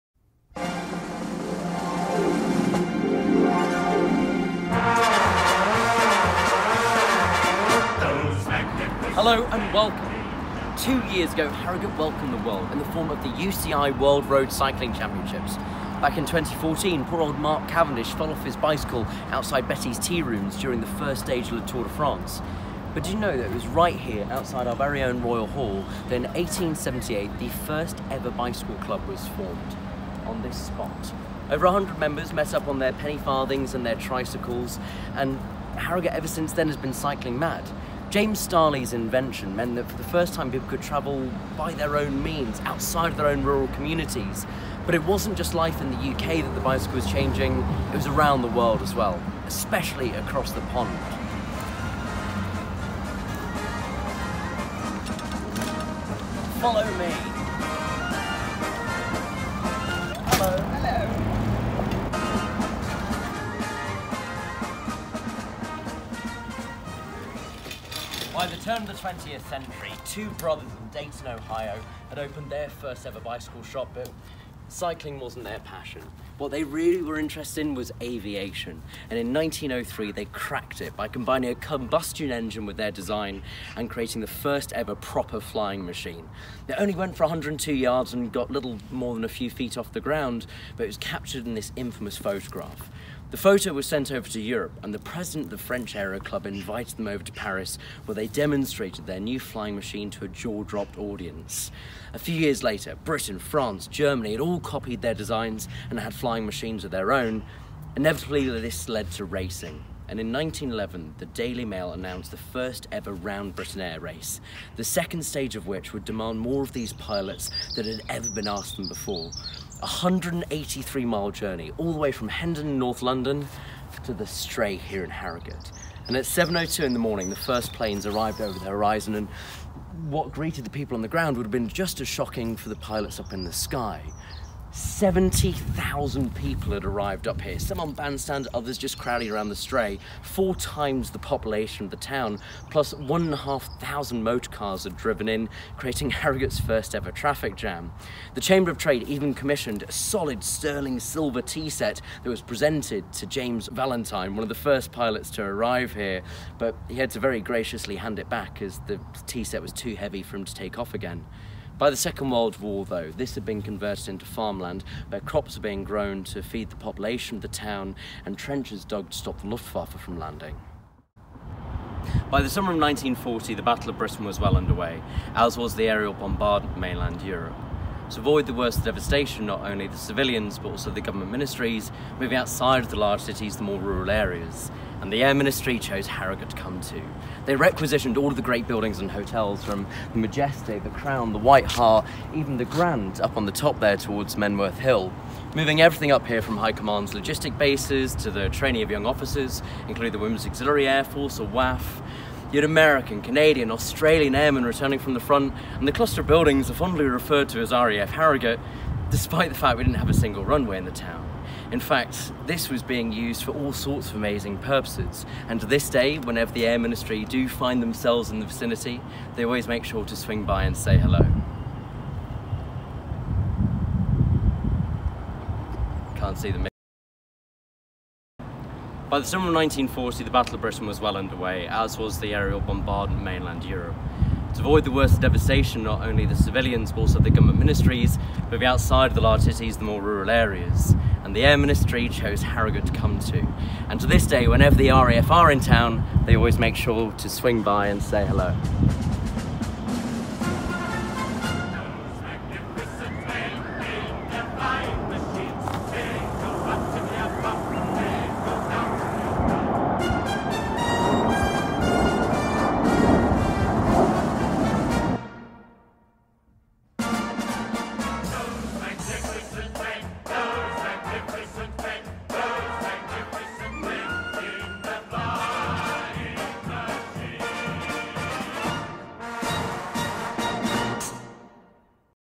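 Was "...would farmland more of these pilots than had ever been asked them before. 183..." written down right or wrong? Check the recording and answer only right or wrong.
wrong.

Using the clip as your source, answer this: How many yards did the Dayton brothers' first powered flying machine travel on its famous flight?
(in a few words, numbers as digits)
102 yards.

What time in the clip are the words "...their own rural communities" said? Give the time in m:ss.
0:43.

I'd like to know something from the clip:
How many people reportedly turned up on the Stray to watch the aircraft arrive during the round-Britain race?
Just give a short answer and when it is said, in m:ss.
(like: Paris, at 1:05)
70,000, at 2:14.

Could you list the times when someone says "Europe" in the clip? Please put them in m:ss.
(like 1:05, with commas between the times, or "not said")
1:34, 2:57, 3:53.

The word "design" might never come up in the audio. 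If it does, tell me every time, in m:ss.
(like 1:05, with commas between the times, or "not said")
1:22, 1:45.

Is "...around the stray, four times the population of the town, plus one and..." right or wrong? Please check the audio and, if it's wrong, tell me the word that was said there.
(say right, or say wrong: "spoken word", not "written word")
right.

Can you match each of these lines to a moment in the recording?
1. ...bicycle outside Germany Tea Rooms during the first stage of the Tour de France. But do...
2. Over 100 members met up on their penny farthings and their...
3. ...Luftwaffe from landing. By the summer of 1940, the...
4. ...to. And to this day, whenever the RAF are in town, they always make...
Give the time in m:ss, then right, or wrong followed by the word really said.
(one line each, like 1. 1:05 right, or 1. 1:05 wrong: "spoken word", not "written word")
1. 0:18 wrong: "Bettys", not "Germany"
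2. 0:31 right
3. 2:49 right
4. 4:03 right.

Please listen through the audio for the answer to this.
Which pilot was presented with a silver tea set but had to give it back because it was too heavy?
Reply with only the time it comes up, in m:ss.
2:33.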